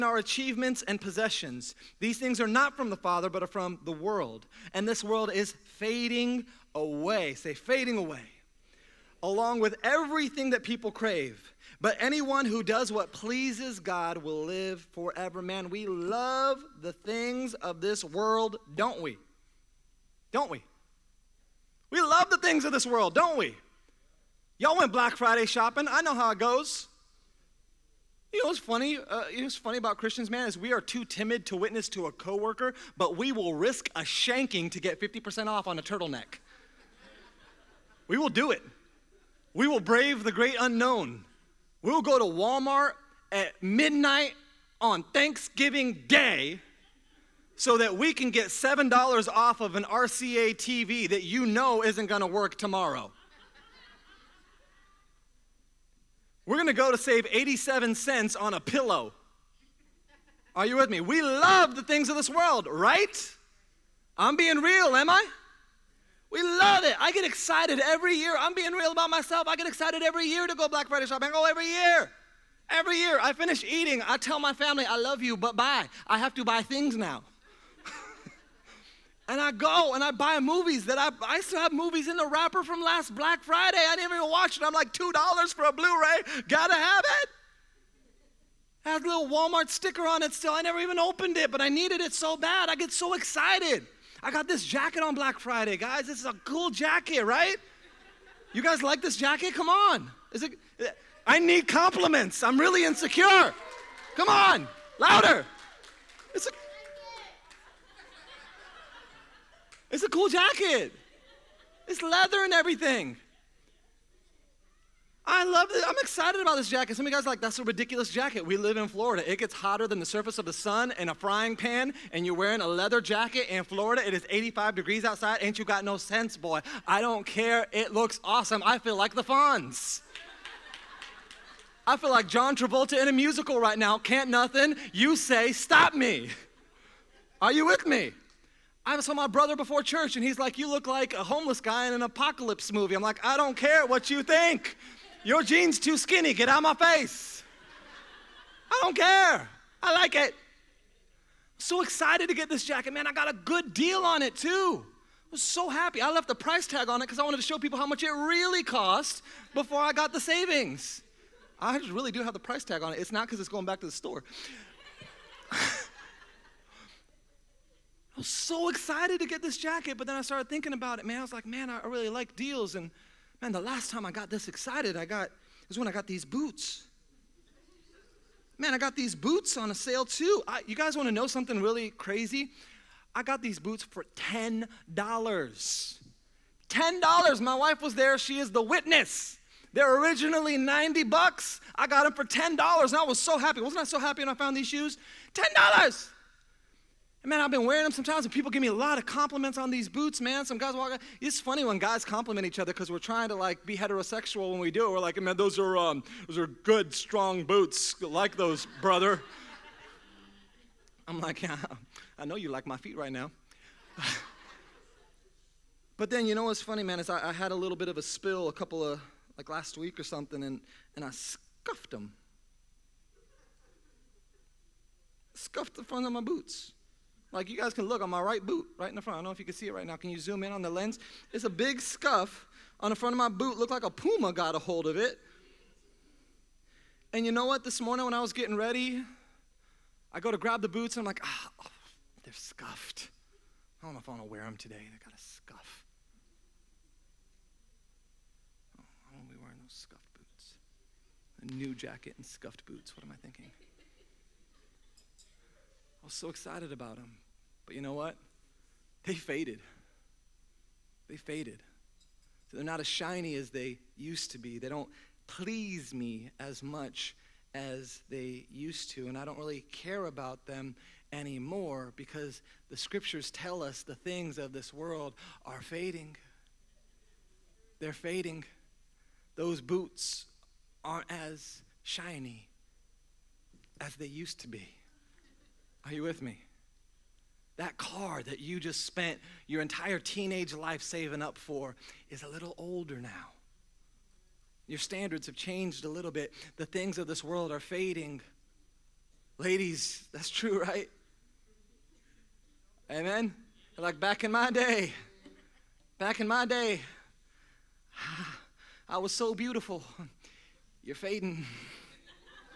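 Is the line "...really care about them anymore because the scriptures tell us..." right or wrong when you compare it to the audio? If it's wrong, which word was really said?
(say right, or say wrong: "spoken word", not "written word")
right.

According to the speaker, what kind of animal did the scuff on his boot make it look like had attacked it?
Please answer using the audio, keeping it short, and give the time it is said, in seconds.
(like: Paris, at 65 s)
puma, at 233 s.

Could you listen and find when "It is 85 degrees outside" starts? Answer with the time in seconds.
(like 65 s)
124 s.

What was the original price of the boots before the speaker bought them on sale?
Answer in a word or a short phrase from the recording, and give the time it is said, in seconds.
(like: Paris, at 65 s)
$90, at 190 s.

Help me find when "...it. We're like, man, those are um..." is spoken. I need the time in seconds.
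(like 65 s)
204 s.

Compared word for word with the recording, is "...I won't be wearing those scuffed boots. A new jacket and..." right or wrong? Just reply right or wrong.
right.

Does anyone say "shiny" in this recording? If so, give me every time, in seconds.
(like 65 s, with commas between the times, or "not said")
262 s, 281 s.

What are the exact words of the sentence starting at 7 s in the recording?
Say, fading away along with everything that people crave.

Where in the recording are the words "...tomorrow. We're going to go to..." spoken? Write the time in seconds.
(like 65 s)
52 s.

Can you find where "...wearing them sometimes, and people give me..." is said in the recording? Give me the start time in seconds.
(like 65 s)
197 s.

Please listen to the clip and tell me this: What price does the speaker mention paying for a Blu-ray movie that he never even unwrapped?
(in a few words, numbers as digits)
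$2.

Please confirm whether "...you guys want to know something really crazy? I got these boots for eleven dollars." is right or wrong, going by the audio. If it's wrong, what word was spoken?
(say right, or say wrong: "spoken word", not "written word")
wrong: "ten", not "eleven".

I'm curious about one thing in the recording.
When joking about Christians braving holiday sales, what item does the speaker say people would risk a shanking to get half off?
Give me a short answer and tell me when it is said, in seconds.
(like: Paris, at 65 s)
turtleneck, at 35 s.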